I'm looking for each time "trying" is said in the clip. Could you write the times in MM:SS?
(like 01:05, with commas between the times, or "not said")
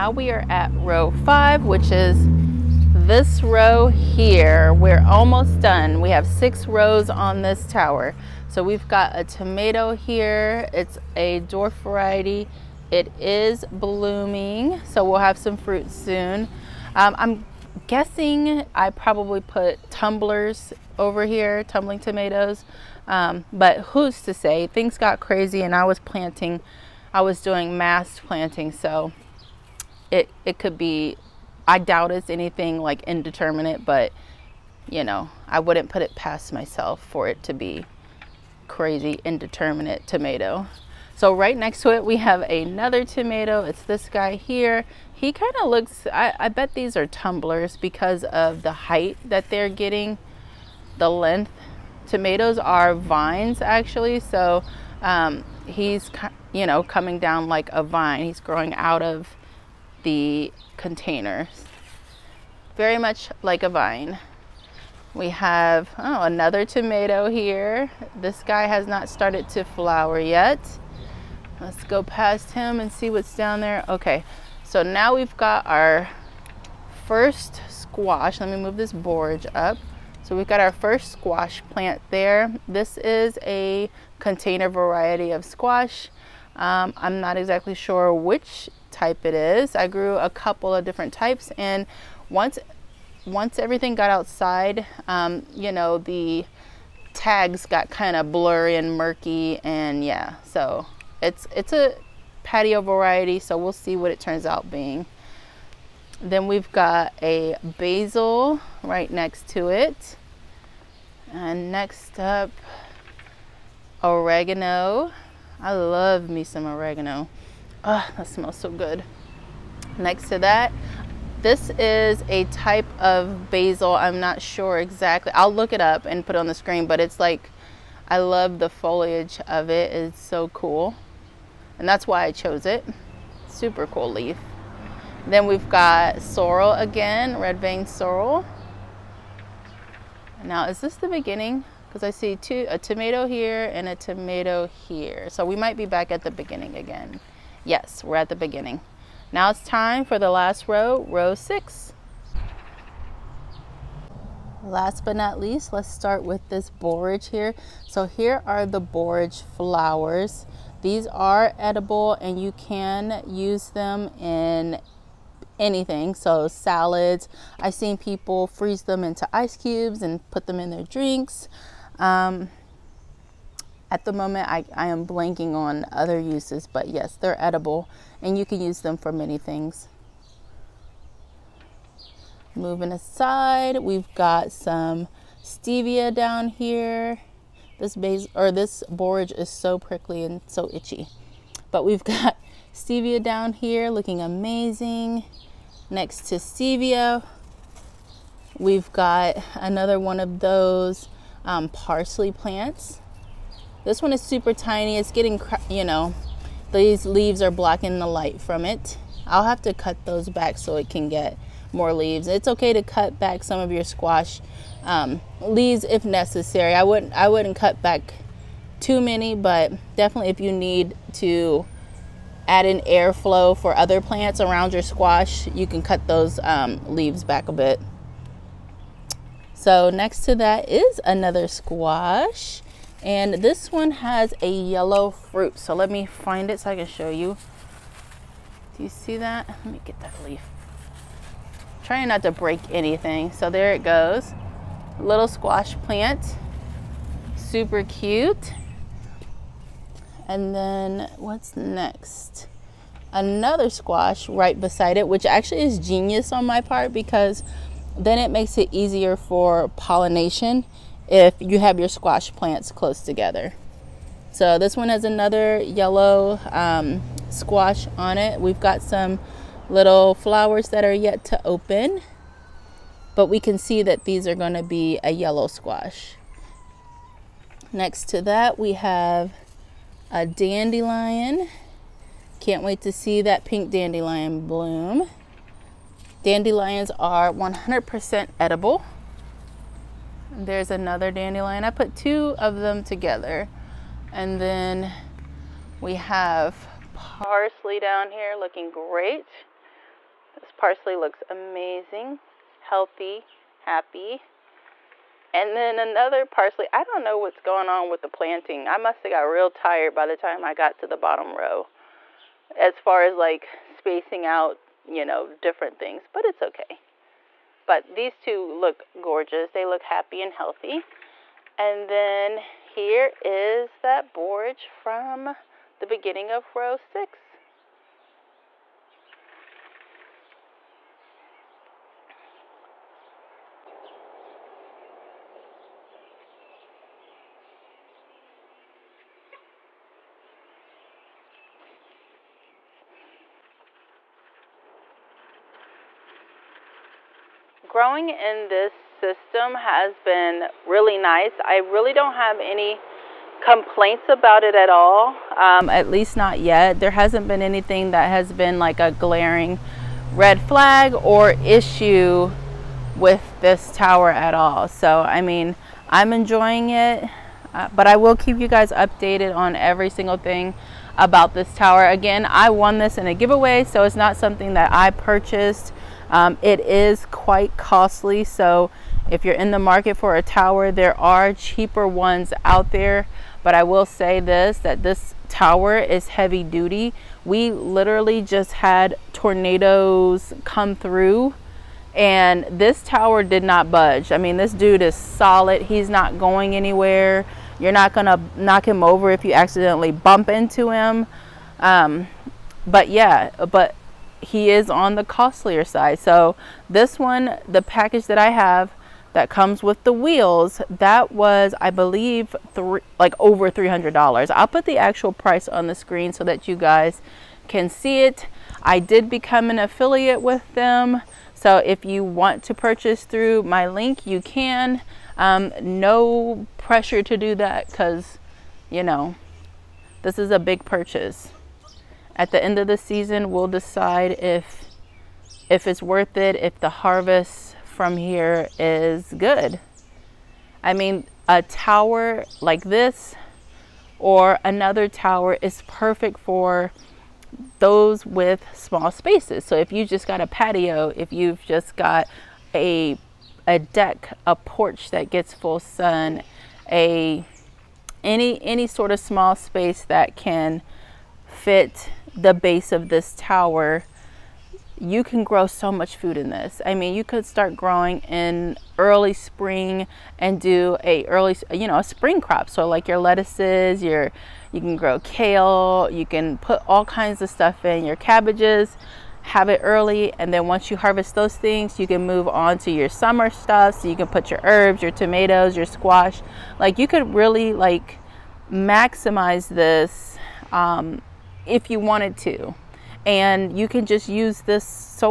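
04:01.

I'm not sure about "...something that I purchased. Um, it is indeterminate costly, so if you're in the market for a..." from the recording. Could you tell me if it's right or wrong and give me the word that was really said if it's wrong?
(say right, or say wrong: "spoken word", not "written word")
wrong: "quite", not "indeterminate".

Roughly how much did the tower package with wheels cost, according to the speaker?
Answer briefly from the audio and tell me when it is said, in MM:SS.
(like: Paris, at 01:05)
over $300, at 06:53.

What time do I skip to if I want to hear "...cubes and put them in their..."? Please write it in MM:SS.
02:49.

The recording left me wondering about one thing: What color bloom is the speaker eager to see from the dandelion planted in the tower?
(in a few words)
pink.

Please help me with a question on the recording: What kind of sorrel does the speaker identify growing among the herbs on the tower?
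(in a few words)
red vein sorrel.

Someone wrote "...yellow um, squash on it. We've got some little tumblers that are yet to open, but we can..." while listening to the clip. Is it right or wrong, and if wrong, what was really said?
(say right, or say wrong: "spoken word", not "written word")
wrong: "flowers", not "tumblers".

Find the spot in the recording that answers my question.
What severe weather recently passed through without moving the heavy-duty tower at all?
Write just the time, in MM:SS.
06:29.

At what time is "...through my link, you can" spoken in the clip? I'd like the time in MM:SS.
07:03.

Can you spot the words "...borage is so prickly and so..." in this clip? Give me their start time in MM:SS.
03:08.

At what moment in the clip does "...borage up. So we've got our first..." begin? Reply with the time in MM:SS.
01:18.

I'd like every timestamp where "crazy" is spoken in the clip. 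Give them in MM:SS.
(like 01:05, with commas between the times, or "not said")
00:25, 00:38.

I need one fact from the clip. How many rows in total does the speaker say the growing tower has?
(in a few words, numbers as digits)
6.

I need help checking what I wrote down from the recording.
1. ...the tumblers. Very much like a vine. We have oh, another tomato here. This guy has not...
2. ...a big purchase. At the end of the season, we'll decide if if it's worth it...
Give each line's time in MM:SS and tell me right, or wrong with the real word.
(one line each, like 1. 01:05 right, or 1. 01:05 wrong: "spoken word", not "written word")
1. 01:00 wrong: "containers", not "tumblers"
2. 07:10 right.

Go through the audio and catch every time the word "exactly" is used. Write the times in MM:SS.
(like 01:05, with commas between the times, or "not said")
01:27, 02:04.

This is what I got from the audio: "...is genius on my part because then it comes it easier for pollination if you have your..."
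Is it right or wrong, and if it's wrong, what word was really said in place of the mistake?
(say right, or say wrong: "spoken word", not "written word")
wrong: "makes", not "comes".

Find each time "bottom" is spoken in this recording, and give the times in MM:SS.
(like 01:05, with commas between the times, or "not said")
05:10.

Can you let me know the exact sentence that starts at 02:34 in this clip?
Last but not least, let's start with this borage here.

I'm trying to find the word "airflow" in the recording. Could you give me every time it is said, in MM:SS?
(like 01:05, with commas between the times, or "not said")
03:42.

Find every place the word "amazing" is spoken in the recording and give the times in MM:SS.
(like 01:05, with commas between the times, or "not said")
03:14, 05:01.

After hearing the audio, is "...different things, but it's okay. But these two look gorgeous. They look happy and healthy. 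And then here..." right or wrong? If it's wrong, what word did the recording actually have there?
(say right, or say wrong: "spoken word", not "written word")
right.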